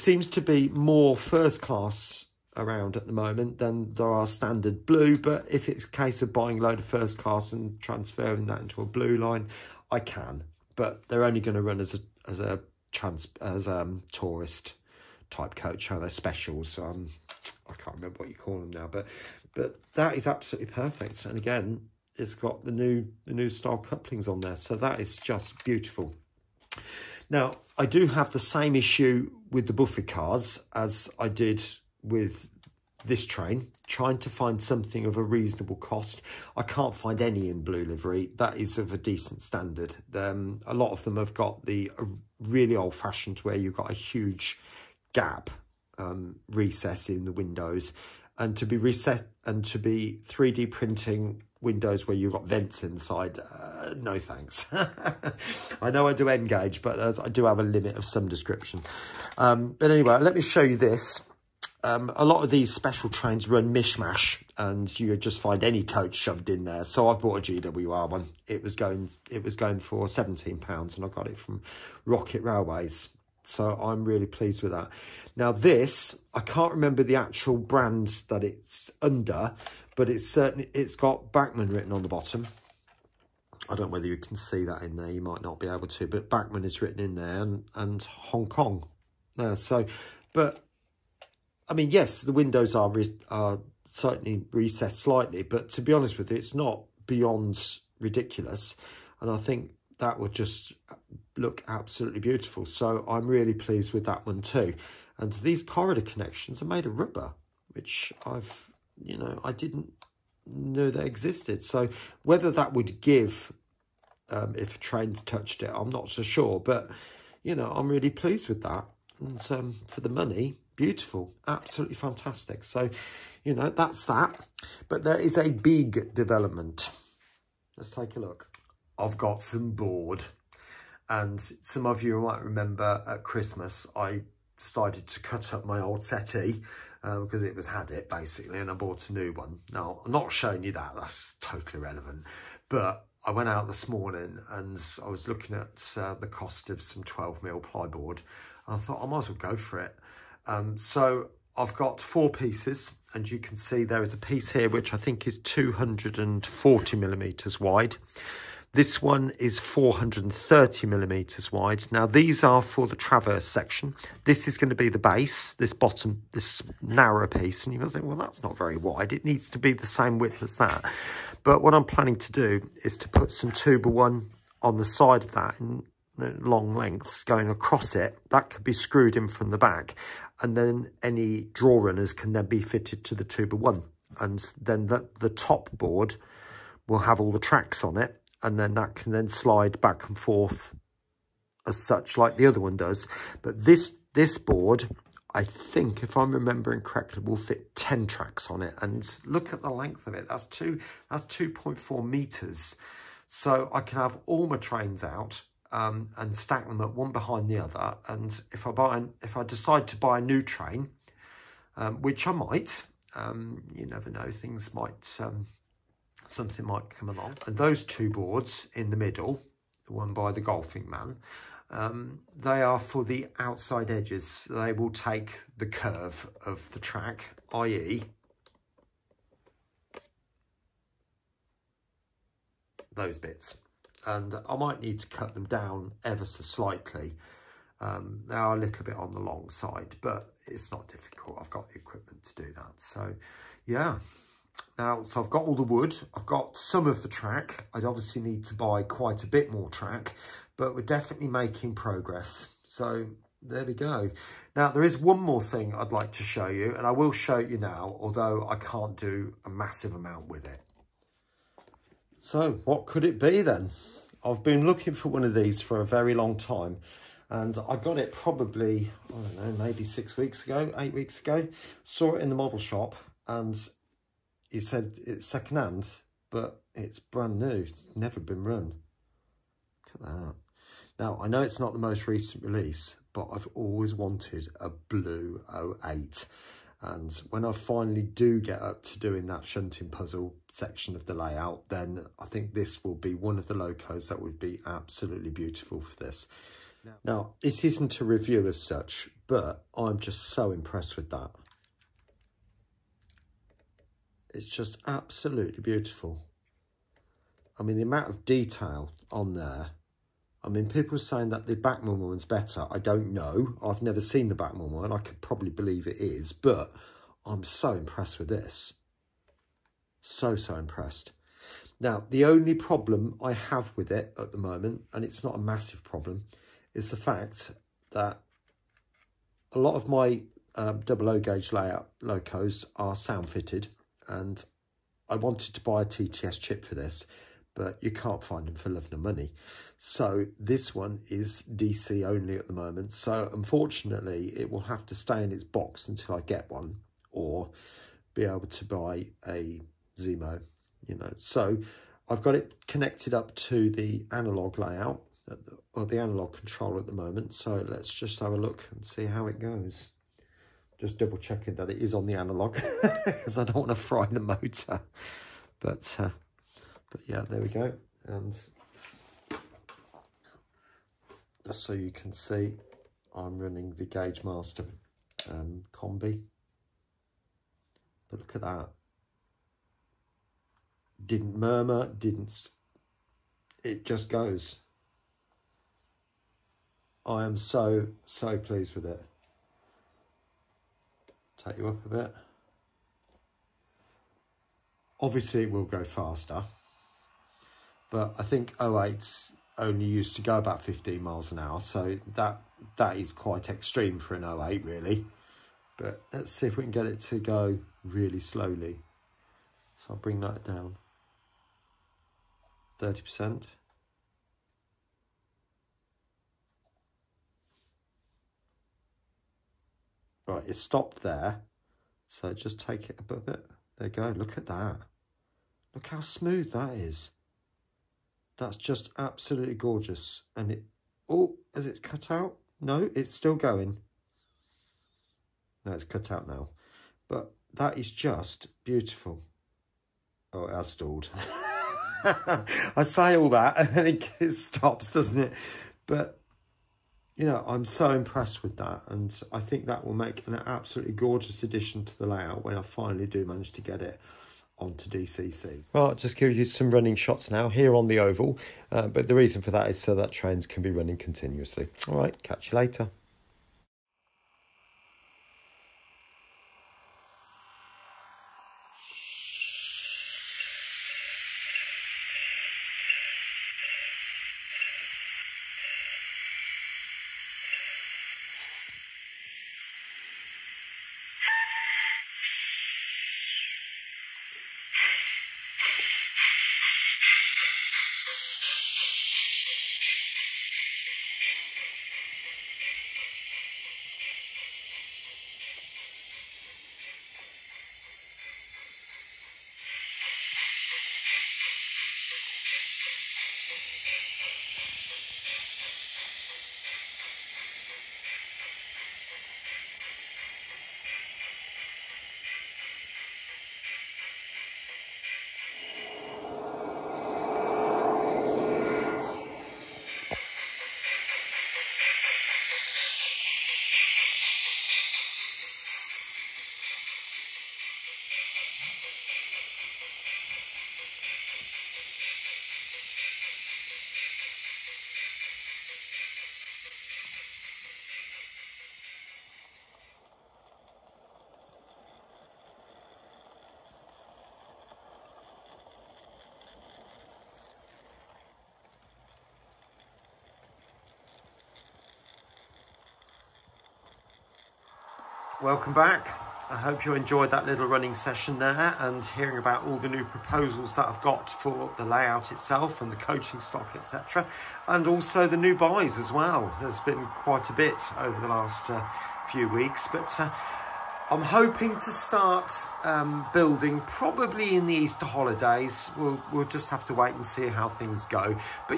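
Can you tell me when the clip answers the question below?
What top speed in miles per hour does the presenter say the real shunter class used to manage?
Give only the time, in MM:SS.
06:40.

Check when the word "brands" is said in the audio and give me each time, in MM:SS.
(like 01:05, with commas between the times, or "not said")
01:17, 04:36.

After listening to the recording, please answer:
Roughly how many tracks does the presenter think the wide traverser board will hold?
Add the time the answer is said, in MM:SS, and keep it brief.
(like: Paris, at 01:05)
10, at 03:17.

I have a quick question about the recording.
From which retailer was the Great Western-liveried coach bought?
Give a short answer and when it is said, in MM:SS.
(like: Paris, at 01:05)
Rocket Railways, at 01:12.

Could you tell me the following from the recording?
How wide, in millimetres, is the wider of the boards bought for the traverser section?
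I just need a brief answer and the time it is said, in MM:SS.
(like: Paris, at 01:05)
430 millimetres, at 02:39.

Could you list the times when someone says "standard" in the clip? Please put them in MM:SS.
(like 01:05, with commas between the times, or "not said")
00:04, 00:39.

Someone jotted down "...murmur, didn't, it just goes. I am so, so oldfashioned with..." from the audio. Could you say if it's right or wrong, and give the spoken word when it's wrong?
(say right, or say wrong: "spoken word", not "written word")
wrong: "pleased", not "oldfashioned".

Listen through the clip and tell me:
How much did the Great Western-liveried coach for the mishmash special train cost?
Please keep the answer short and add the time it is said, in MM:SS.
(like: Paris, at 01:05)
£17, at 01:10.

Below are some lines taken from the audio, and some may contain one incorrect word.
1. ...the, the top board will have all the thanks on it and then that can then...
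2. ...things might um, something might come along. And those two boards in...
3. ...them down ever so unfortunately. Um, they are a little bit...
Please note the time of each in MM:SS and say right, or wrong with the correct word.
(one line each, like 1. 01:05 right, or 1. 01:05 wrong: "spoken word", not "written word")
1. 03:04 wrong: "tracks", not "thanks"
2. 03:34 right
3. 03:55 wrong: "slightly", not "unfortunately".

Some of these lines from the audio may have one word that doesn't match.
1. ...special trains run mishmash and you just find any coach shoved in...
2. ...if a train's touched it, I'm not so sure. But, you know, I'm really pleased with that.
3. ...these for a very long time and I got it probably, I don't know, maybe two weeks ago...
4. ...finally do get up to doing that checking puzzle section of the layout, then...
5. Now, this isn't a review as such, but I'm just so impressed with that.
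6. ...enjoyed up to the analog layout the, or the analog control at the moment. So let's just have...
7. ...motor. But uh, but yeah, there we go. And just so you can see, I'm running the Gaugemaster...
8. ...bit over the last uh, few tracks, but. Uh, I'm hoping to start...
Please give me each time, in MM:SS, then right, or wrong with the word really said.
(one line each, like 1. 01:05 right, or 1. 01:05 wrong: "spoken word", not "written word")
1. 01:02 right
2. 01:54 right
3. 04:25 wrong: "six", not "two"
4. 04:47 wrong: "shunting", not "checking"
5. 04:57 right
6. 05:52 wrong: "connected", not "enjoyed"
7. 06:04 right
8. 09:27 wrong: "weeks", not "tracks".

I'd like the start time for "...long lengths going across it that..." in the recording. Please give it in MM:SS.
02:56.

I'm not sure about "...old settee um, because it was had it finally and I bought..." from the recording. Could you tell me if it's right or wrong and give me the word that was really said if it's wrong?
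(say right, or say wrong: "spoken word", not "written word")
wrong: "basically", not "finally".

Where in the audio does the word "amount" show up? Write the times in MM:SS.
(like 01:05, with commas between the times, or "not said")
04:19, 05:07.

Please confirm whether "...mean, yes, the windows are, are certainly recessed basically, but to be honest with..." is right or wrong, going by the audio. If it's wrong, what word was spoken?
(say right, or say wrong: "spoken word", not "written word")
wrong: "slightly", not "basically".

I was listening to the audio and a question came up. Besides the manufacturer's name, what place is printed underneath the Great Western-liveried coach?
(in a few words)
Hong Kong.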